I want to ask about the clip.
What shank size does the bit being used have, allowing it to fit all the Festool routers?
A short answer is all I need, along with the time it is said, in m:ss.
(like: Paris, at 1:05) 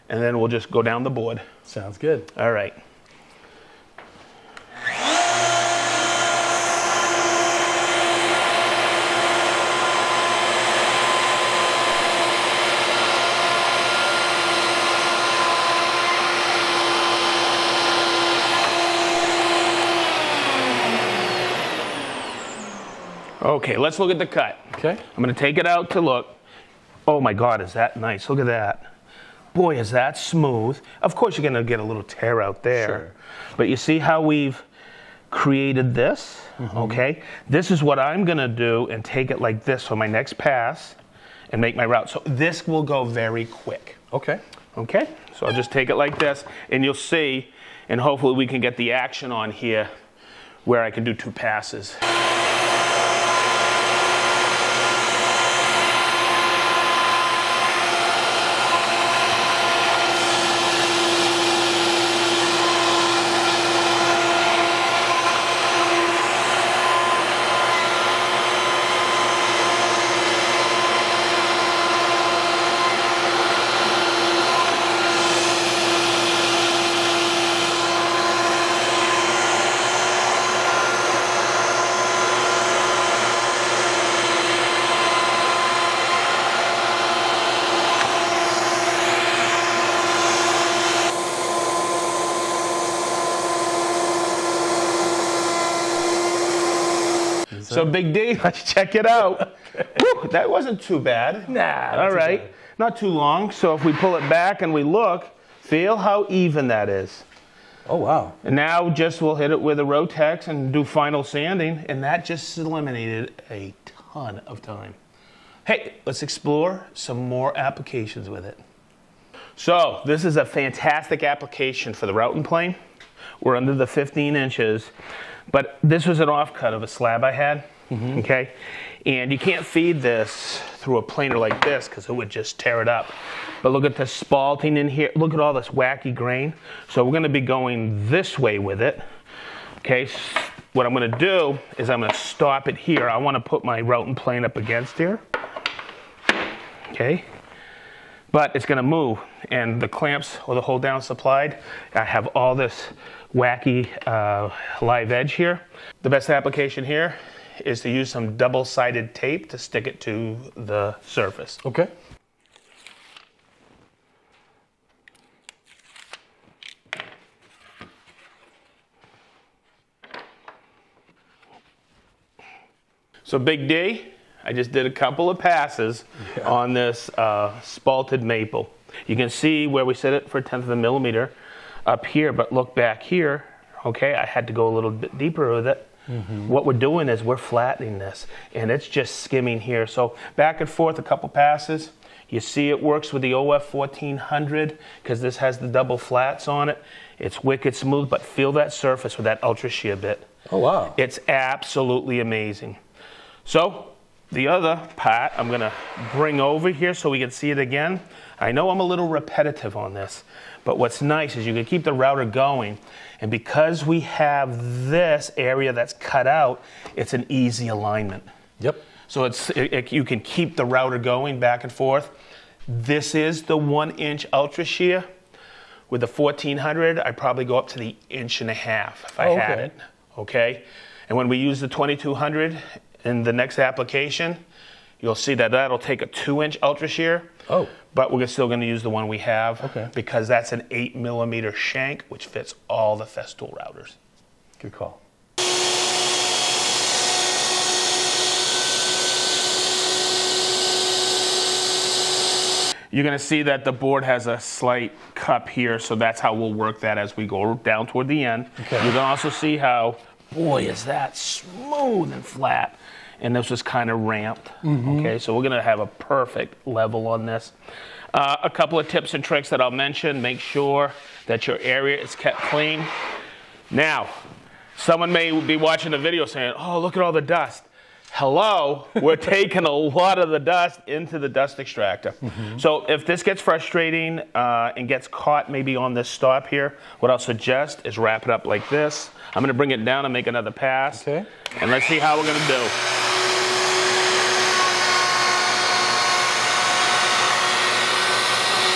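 8 millimeter, at 4:00.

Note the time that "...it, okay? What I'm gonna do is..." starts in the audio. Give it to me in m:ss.
2:18.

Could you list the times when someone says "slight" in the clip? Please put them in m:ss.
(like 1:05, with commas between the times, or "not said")
4:14.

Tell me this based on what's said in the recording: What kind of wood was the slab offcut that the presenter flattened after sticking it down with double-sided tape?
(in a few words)
Spalted maple.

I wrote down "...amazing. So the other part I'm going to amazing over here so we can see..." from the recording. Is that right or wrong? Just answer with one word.
wrong.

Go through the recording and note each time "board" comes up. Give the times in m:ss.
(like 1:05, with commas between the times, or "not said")
0:01, 4:13.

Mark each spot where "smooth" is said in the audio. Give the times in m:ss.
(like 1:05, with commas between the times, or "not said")
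0:30, 3:17, 4:21.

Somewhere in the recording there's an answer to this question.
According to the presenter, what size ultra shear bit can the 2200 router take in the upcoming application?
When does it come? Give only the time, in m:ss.
3:56.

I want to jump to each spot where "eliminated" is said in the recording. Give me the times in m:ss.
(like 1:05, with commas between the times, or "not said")
1:52.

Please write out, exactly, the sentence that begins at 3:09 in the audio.
So back and forth, a couple passes.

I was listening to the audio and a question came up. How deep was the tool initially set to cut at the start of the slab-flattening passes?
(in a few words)
A tenth of a millimeter.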